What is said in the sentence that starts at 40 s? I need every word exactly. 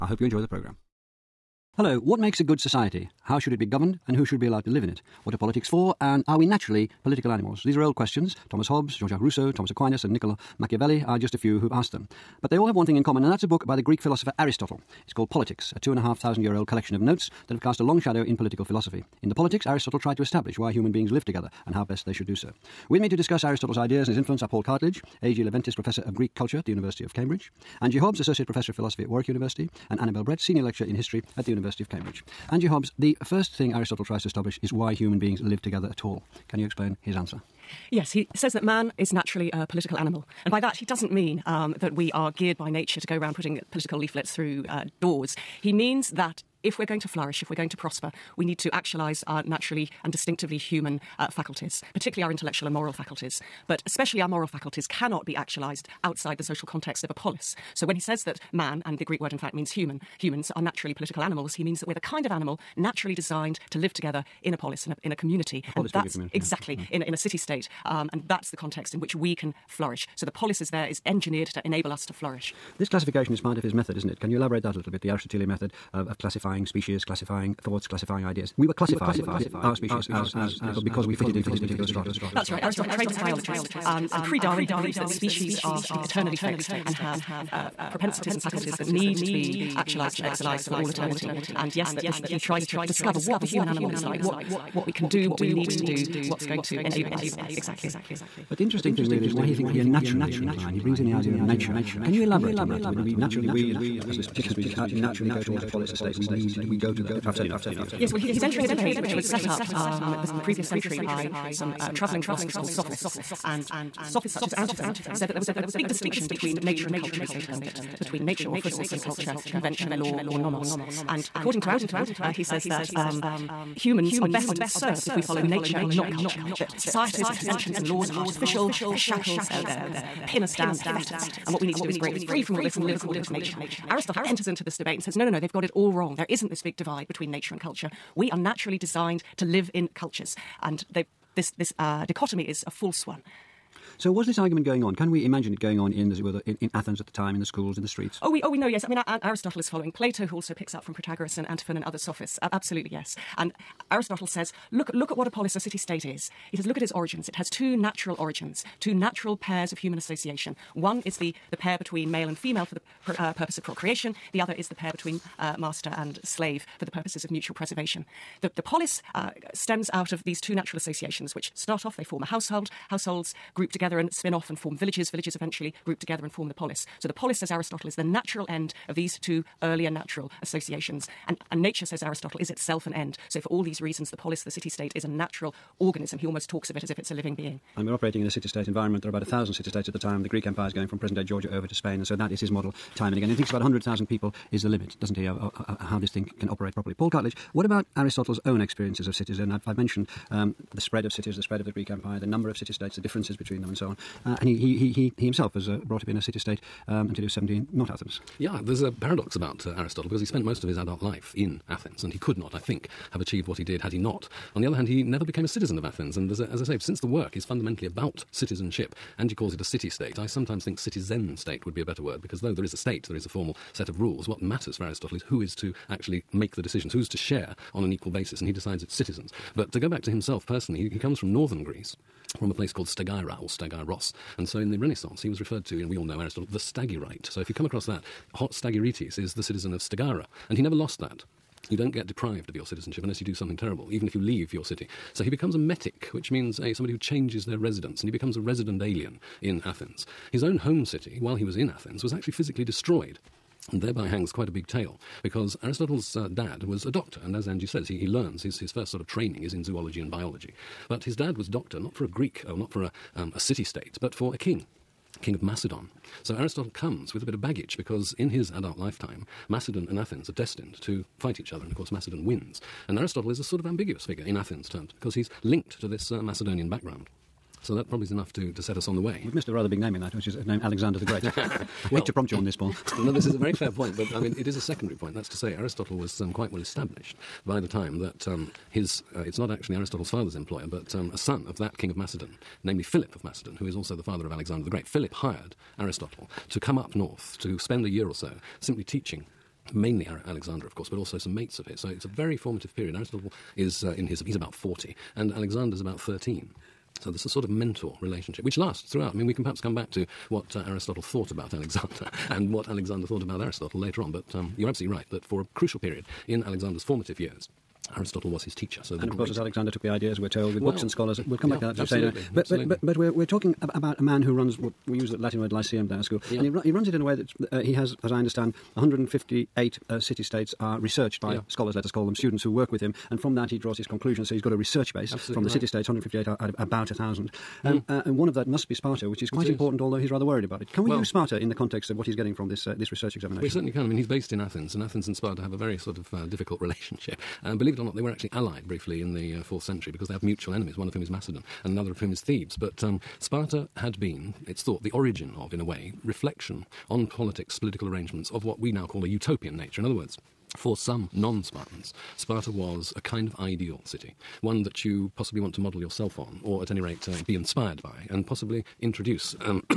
And by that, he doesn't mean um, that we are geared by nature to go around putting political leaflets through uh, doors.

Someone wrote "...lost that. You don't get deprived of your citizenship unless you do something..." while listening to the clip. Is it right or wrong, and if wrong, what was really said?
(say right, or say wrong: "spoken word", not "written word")
right.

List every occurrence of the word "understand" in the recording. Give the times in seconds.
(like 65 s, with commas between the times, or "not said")
328 s.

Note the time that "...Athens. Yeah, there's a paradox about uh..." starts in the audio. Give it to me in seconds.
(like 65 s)
207 s.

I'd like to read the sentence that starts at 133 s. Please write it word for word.
Aristotle enters into this debate and says, no, no, no, they've got it all wrong.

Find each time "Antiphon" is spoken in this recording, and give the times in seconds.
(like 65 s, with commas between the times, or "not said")
114 s, 121 s, 151 s.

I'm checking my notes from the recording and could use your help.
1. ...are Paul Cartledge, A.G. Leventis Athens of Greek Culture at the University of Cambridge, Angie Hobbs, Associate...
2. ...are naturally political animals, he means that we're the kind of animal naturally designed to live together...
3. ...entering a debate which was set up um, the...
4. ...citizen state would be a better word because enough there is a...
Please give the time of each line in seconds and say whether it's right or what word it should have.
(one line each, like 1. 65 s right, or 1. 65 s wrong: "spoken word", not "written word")
1. 24 s wrong: "Professor", not "Athens"
2. 60 s right
3. 108 s right
4. 220 s wrong: "though", not "enough".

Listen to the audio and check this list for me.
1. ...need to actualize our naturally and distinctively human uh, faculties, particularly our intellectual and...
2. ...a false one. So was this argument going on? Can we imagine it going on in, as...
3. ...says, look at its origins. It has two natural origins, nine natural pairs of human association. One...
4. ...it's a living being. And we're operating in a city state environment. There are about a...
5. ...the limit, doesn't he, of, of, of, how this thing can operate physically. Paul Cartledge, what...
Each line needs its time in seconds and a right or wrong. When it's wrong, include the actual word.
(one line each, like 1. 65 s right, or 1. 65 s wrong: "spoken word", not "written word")
1. 48 s right
2. 142 s right
3. 156 s wrong: "two", not "nine"
4. 186 s right
5. 194 s wrong: "properly", not "physically".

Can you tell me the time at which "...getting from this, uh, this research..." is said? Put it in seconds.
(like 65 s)
342 s.